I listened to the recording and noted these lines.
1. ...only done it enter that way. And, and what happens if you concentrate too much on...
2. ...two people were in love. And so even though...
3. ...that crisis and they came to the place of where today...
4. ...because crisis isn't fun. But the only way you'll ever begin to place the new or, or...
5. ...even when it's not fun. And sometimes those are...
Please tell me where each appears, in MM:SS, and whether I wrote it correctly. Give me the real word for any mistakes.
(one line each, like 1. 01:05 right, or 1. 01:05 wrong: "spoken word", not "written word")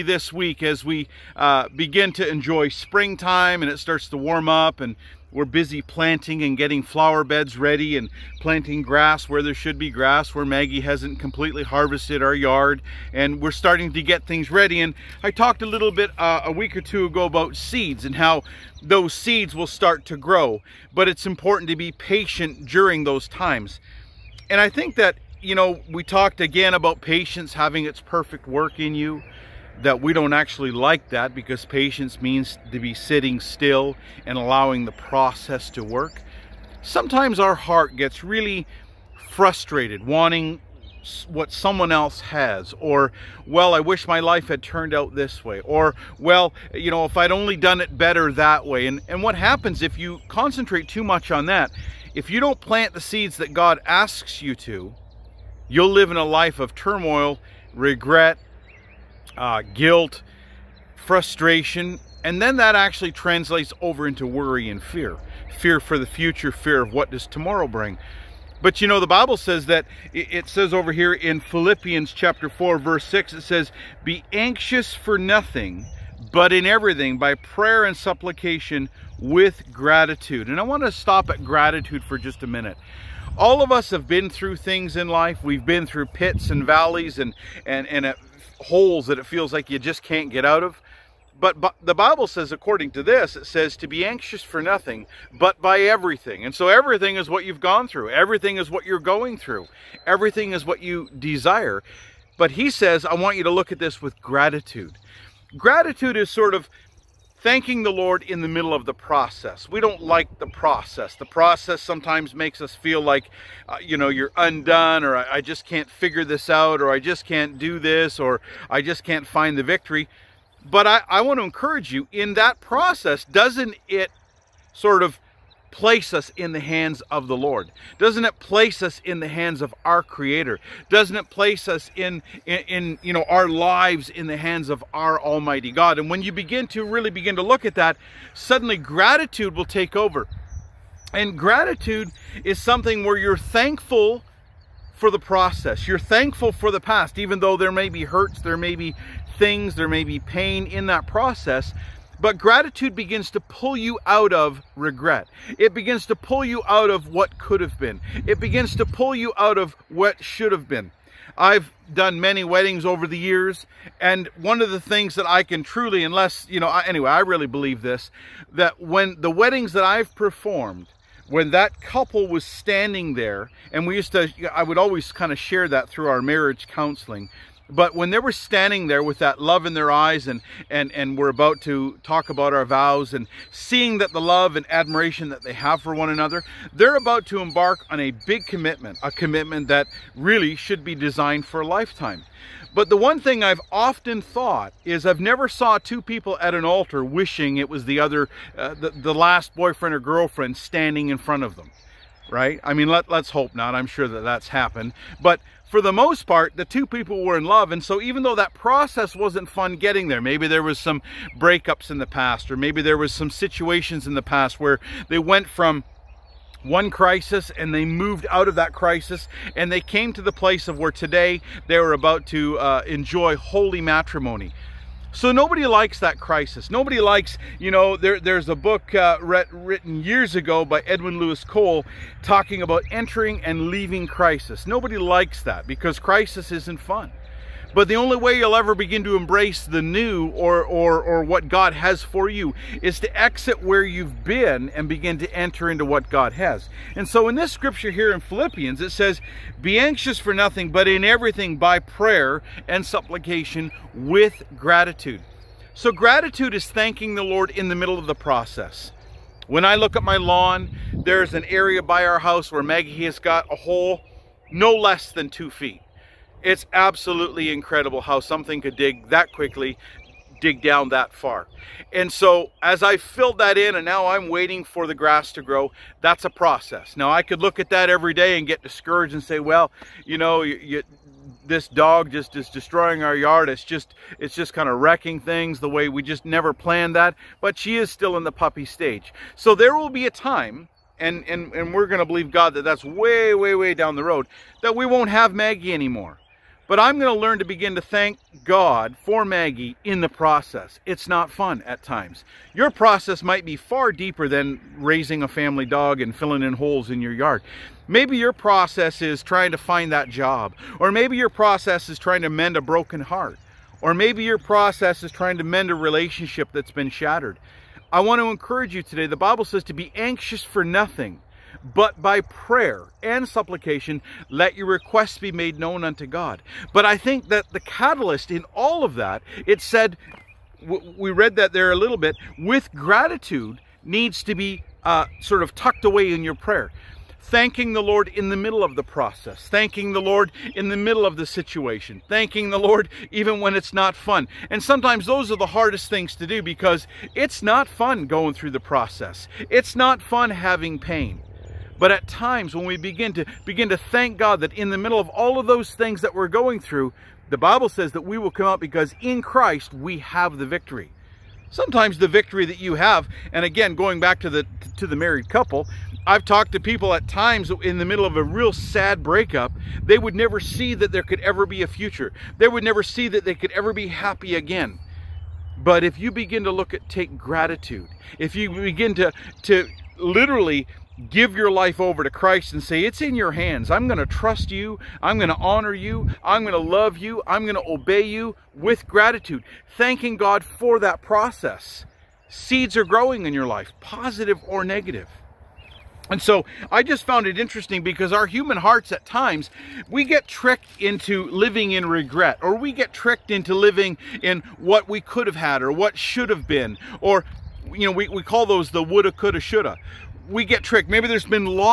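1. 00:47 wrong: "better", not "enter"
2. 03:26 right
3. 03:38 right
4. 03:55 wrong: "embrace", not "place"
5. 05:43 right.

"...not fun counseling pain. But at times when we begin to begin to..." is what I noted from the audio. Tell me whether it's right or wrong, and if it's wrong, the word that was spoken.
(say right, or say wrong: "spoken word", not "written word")
wrong: "having", not "counseling".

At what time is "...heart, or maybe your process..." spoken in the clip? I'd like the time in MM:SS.
05:12.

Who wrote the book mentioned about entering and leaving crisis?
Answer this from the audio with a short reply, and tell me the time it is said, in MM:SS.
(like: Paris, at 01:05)
Edwin Louis Cole, at 03:50.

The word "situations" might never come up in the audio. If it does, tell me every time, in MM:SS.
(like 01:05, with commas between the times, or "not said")
03:33, 05:41.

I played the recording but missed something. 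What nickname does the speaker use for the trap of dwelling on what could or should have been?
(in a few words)
woulda, coulda, shoulda.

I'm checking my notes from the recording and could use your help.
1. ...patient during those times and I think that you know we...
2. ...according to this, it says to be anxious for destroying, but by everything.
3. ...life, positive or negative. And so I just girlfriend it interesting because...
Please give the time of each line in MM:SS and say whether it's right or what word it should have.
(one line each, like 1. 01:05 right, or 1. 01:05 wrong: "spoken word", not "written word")
1. 00:21 right
2. 01:32 wrong: "nothing", not "destroying"
3. 06:33 wrong: "found", not "girlfriend".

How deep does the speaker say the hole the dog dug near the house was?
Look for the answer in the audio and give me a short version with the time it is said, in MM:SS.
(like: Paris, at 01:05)
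2 feet, at 04:25.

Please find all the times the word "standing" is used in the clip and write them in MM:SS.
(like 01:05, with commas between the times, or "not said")
02:52, 02:58, 03:20.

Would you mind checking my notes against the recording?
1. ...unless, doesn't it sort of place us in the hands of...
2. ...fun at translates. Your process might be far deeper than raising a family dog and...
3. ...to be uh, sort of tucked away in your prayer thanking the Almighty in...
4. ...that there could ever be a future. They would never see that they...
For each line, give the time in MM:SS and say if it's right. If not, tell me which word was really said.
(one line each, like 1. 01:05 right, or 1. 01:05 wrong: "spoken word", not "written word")
1. 02:02 wrong: "process", not "unless"
2. 05:01 wrong: "times", not "translates"
3. 05:34 wrong: "Lord", not "Almighty"
4. 06:10 right.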